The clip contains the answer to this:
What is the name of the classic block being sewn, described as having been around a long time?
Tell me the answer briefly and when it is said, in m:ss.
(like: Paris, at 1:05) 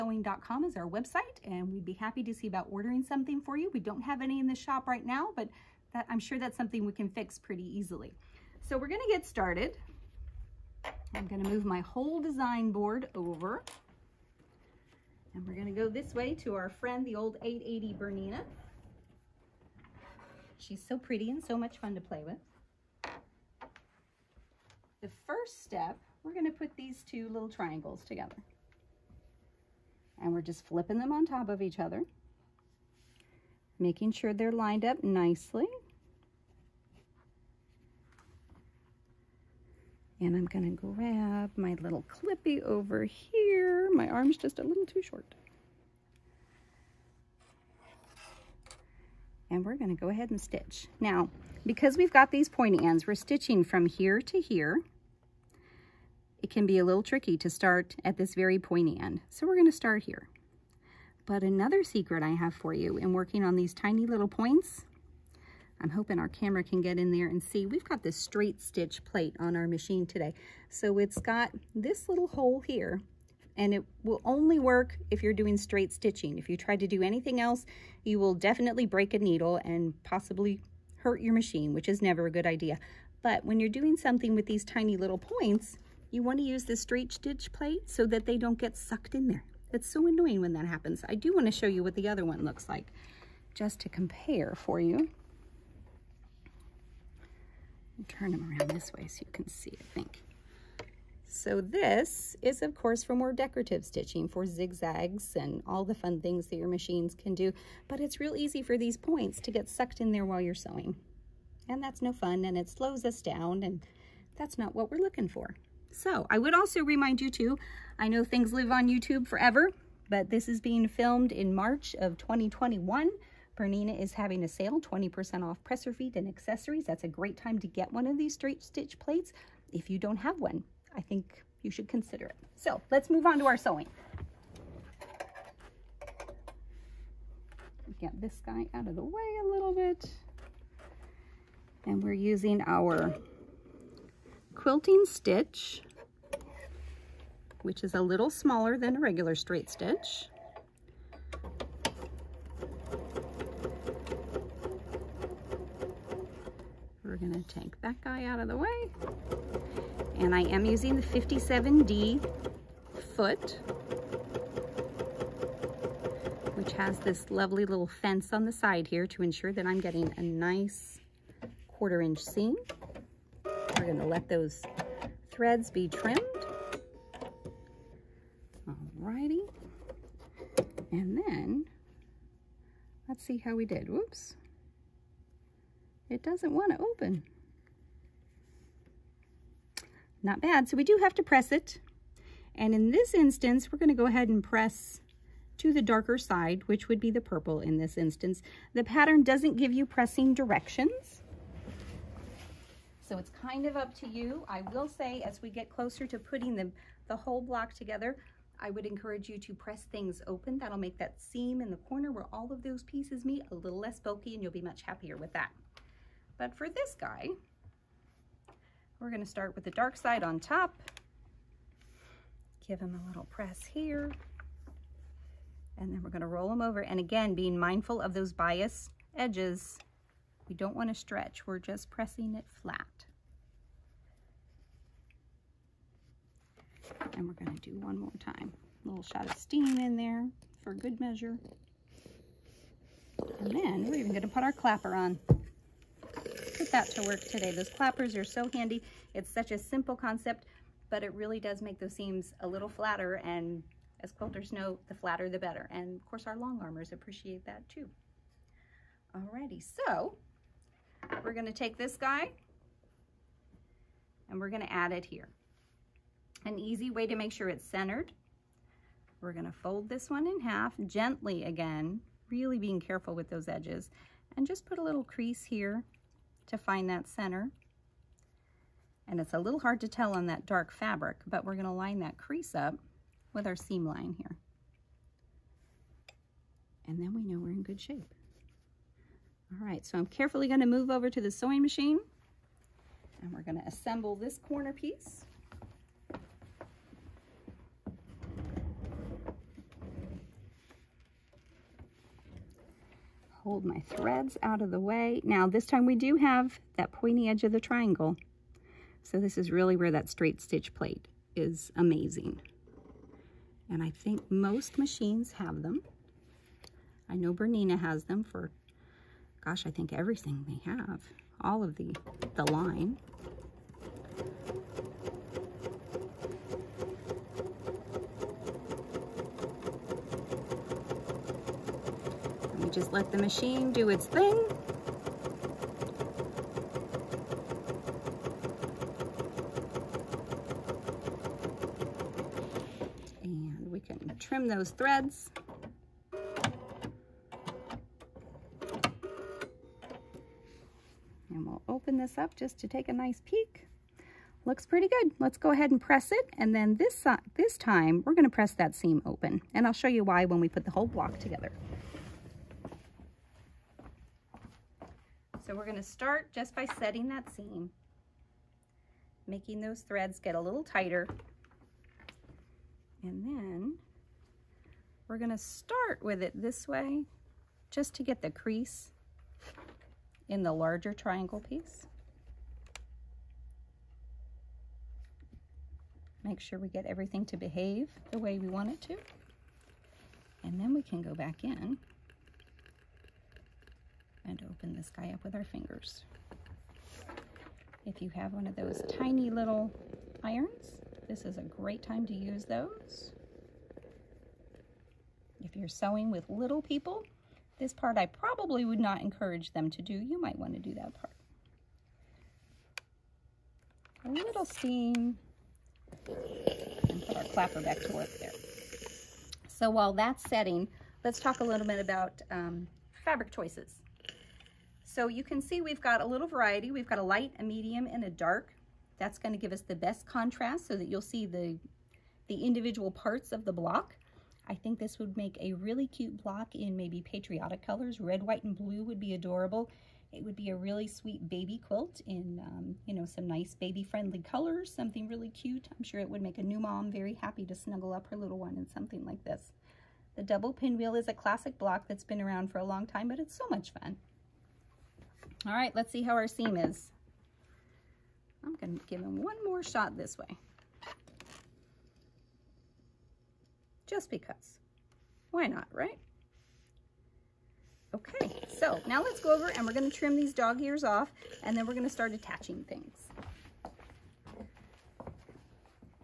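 Double pinwheel, at 7:30.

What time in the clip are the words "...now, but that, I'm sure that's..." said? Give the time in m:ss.
0:05.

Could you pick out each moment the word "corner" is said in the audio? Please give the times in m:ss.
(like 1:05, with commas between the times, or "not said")
3:31, 4:54.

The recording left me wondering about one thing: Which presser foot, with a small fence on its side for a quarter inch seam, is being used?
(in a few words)
57D.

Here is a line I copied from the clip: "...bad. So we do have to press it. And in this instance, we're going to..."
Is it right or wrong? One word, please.
right.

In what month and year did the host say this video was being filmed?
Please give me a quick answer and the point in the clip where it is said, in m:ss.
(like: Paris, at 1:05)
March 2021, at 2:01.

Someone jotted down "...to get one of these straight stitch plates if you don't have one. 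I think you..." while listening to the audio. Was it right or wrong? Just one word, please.
right.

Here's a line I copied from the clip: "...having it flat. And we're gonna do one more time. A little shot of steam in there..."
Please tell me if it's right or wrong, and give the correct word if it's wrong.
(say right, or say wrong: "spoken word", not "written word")
wrong: "pressing", not "having".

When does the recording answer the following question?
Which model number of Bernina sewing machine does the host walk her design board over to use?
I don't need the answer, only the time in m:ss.
0:17.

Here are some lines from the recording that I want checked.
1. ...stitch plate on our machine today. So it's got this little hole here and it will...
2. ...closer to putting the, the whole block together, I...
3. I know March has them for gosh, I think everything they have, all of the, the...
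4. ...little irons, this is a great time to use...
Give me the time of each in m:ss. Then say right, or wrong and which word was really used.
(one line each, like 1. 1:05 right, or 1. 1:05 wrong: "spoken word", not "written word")
1. 1:08 right
2. 3:25 right
3. 5:17 wrong: "Bernina", not "March"
4. 6:39 right.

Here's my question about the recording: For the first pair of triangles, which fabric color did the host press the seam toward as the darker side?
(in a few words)
Purple.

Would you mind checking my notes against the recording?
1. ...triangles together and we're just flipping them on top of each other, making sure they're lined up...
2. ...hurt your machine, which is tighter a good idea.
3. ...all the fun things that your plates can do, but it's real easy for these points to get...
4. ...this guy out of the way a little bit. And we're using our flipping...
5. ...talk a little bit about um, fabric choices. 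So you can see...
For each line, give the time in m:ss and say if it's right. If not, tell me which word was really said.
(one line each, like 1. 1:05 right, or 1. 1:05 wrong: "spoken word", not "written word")
1. 0:27 right
2. 1:20 wrong: "never", not "tighter"
3. 1:45 wrong: "machines", not "plates"
4. 2:18 wrong: "quilting", not "flipping"
5. 7:01 right.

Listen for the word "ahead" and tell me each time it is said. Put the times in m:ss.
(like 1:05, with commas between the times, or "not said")
0:50, 3:14, 5:55.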